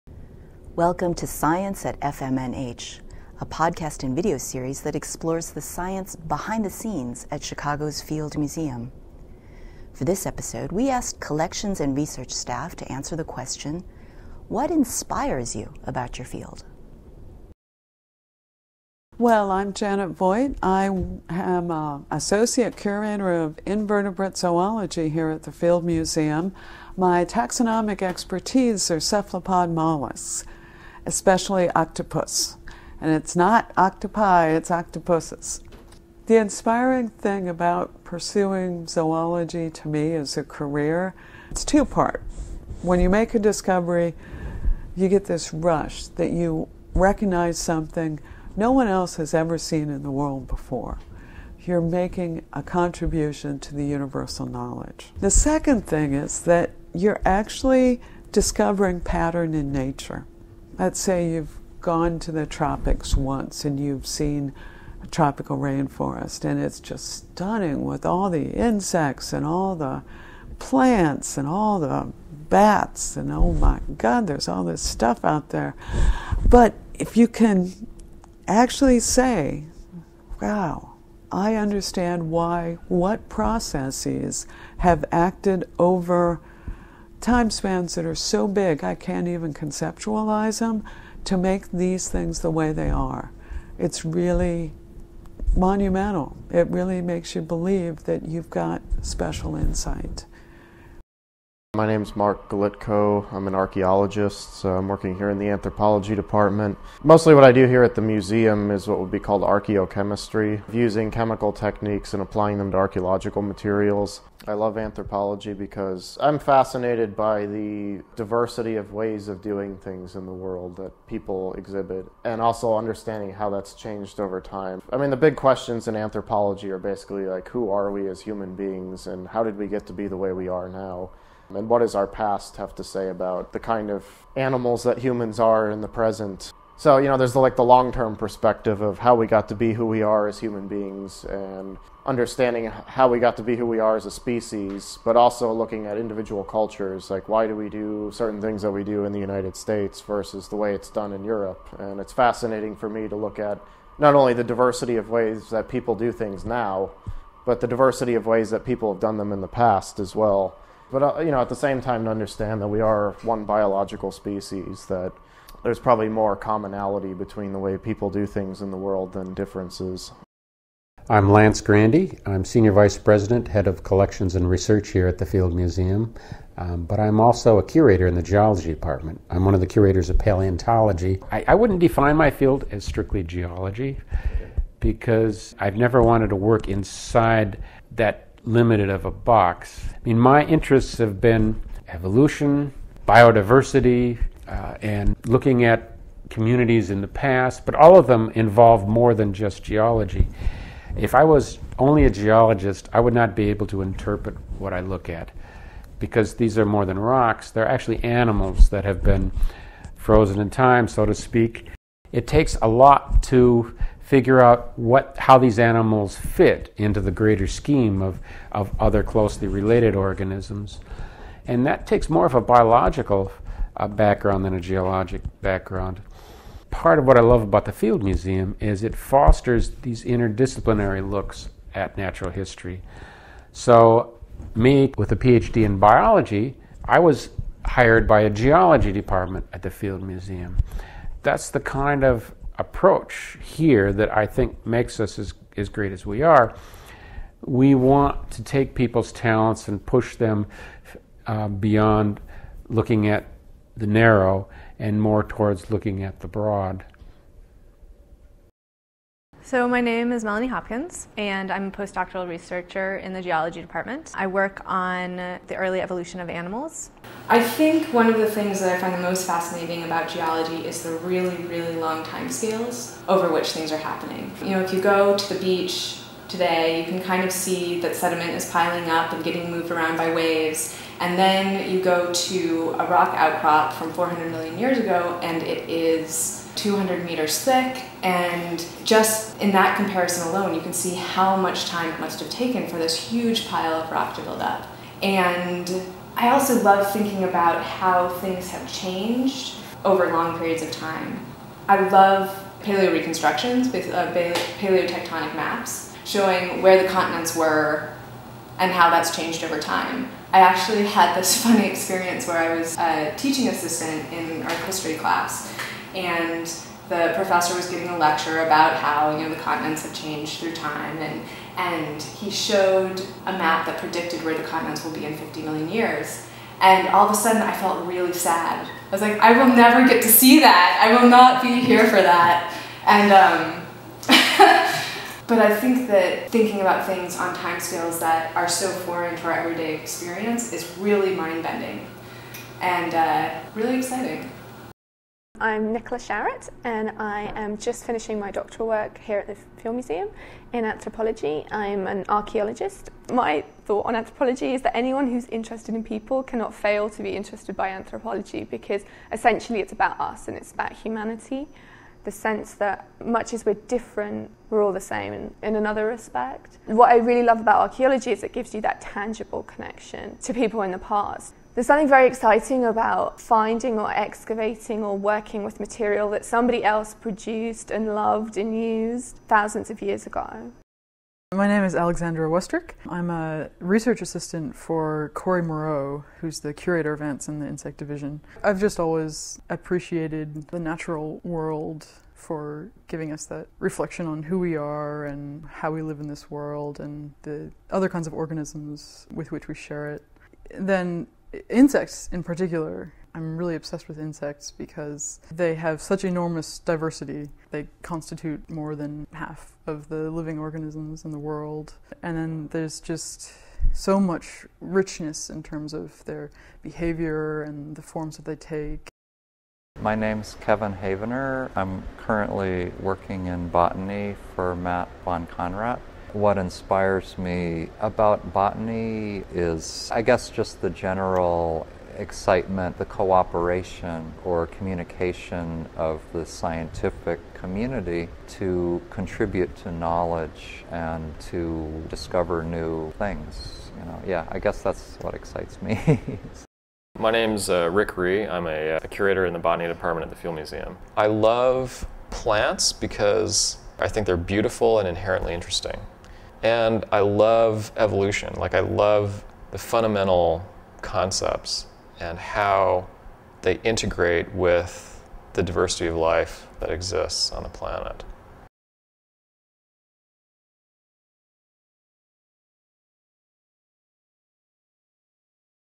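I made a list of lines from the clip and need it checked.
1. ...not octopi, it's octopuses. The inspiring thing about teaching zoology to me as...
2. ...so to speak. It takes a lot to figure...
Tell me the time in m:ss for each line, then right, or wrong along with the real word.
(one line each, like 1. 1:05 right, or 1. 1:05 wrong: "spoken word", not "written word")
1. 0:33 wrong: "pursuing", not "teaching"
2. 3:30 right.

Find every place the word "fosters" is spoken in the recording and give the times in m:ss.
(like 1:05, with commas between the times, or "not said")
3:48.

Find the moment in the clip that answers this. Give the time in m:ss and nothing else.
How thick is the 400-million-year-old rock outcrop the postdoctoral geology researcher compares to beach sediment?
4:46.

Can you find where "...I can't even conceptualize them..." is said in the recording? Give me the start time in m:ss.
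1:28.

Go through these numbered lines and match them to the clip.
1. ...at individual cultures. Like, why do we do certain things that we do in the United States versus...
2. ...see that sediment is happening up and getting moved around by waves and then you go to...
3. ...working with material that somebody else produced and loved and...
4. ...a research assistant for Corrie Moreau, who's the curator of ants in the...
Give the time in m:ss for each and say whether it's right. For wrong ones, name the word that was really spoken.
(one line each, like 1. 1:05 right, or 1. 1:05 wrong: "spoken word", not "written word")
1. 2:25 right
2. 4:37 wrong: "piling", not "happening"
3. 6:14 right
4. 6:23 right.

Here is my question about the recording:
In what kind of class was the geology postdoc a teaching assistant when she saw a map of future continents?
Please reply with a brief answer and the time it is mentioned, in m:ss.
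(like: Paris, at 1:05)
art history, at 5:14.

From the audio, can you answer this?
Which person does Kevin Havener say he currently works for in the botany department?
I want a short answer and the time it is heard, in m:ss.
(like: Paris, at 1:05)
Matt von Konrat, at 7:04.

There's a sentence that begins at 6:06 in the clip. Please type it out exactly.
What I really love about archaeology is it gives you that tangible connection to people in the past.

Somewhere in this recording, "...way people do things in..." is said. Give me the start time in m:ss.
2:47.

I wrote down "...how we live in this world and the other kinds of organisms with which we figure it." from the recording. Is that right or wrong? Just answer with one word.
wrong.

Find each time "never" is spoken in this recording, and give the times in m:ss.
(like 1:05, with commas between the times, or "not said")
3:05, 5:29.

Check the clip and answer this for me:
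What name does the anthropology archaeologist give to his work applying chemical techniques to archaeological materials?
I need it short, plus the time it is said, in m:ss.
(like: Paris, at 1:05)
archaeochemistry, at 1:49.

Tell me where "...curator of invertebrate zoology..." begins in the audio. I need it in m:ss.
0:22.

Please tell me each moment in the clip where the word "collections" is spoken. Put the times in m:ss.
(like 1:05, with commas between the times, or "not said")
0:11, 2:53.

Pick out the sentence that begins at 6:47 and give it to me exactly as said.
They constitute more than half of the living organisms in the world.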